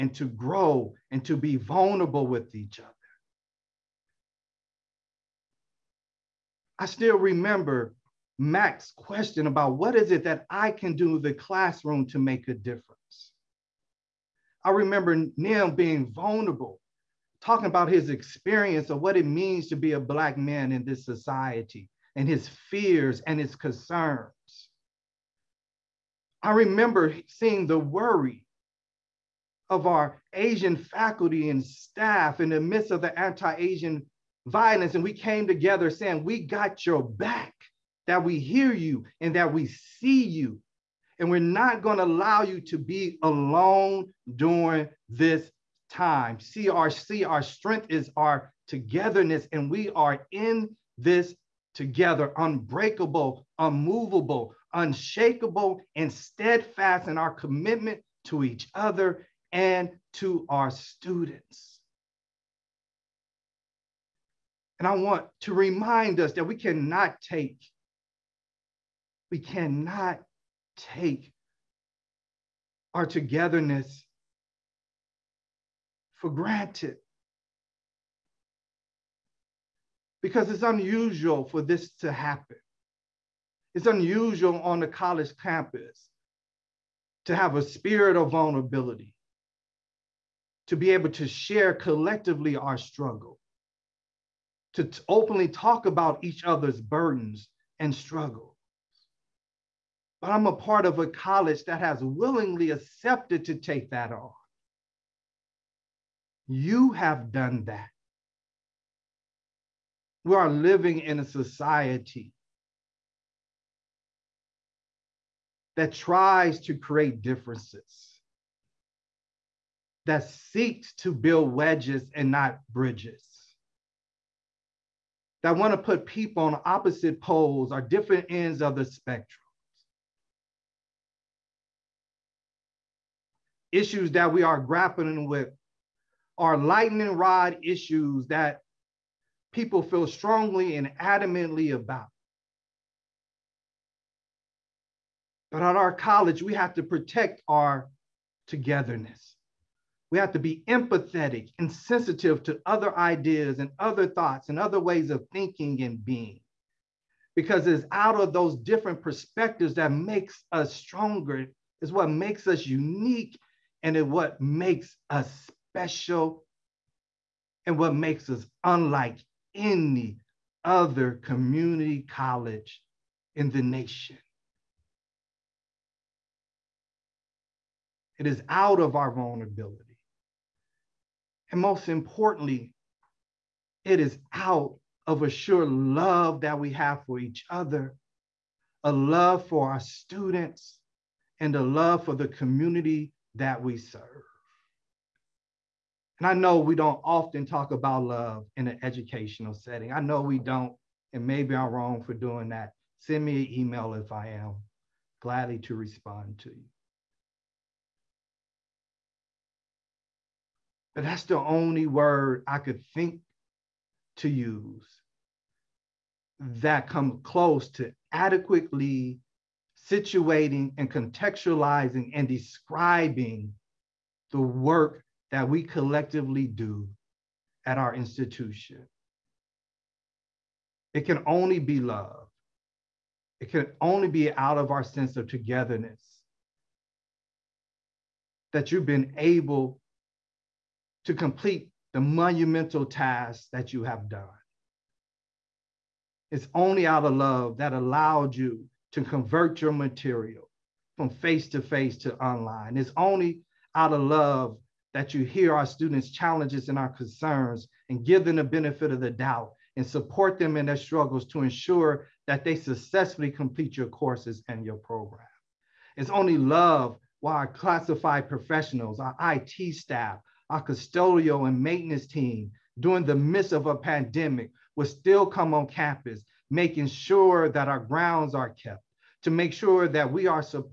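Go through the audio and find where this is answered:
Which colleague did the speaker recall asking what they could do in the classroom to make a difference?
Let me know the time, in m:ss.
0:08.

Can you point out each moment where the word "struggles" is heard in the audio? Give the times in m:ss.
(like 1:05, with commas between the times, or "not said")
1:32, 1:37, 4:20.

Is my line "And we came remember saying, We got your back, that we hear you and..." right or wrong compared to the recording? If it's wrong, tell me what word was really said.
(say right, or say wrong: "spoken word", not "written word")
wrong: "together", not "remember".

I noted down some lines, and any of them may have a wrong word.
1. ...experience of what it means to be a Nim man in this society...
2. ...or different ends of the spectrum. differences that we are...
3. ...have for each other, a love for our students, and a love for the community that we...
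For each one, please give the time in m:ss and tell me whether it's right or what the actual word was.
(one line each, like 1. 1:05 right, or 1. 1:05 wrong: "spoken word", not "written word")
1. 0:18 wrong: "Black", not "Nim"
2. 2:07 wrong: "issues", not "differences"
3. 3:06 right.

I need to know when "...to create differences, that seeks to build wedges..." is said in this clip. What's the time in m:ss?
1:56.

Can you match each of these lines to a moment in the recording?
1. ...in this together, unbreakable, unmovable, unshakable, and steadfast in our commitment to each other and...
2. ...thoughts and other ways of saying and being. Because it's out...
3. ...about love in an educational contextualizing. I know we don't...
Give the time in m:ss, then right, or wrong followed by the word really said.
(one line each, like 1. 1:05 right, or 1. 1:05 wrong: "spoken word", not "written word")
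1. 0:50 right
2. 2:34 wrong: "thinking", not "saying"
3. 3:17 wrong: "setting", not "contextualizing".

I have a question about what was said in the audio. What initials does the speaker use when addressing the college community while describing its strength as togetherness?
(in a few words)
CRC.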